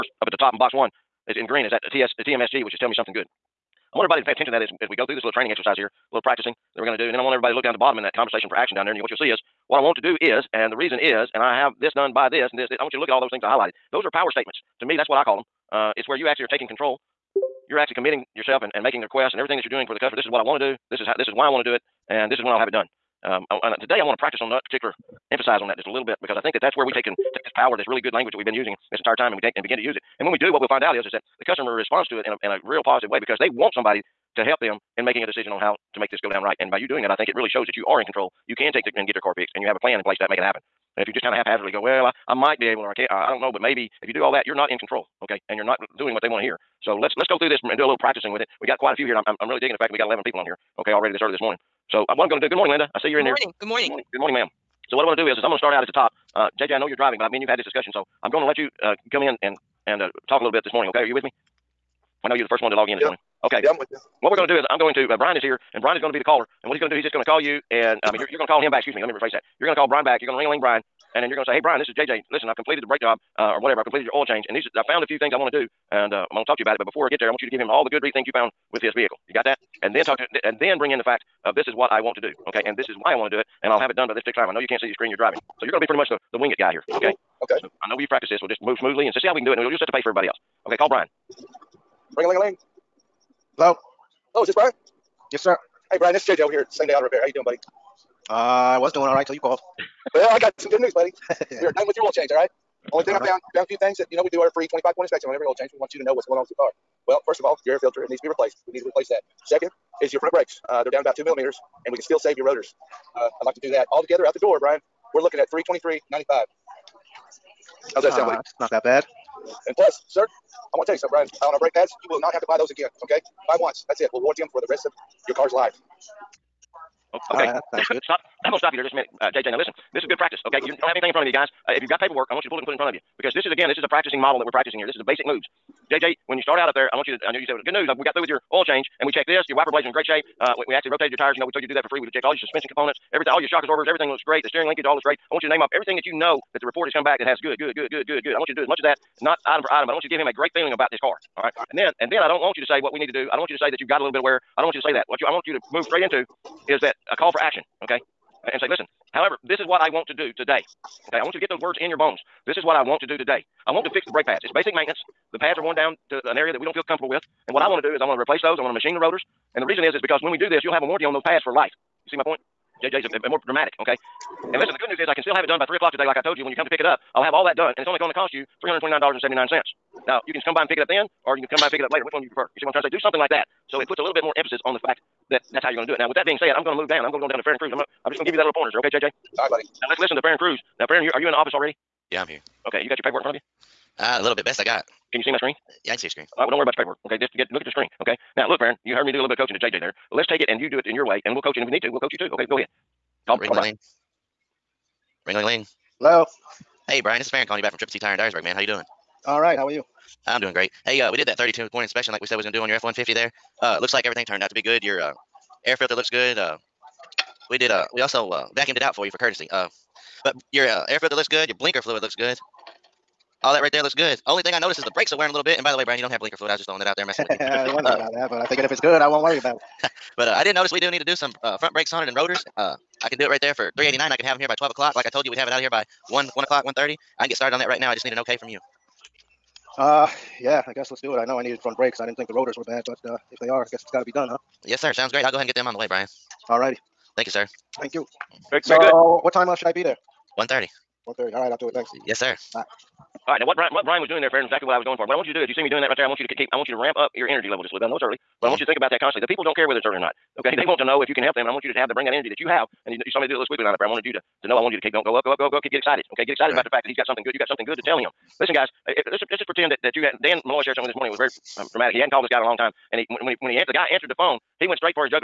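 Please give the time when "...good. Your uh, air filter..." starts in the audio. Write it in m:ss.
3:34.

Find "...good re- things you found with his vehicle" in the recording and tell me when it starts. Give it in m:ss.
1:17.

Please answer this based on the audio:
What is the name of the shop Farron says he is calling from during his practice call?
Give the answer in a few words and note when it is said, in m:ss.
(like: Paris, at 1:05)
Triple T Tire, at 3:27.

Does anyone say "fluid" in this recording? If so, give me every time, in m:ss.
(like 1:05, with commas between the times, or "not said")
3:41, 3:46.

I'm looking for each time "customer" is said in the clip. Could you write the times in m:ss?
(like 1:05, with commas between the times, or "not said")
0:19, 0:31.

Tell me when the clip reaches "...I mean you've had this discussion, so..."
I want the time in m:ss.
0:57.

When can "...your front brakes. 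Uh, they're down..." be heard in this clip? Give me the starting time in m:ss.
1:50.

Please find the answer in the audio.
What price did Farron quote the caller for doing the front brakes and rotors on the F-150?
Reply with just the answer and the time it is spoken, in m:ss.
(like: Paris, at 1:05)
$389, at 3:53.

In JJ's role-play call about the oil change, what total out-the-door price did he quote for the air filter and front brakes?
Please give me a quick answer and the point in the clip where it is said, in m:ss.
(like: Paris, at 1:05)
$323.95, at 1:55.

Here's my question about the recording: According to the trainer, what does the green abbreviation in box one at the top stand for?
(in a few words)
Tell me something good.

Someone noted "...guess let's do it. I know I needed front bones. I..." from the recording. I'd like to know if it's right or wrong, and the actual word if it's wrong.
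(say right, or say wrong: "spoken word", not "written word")
wrong: "brakes", not "bones".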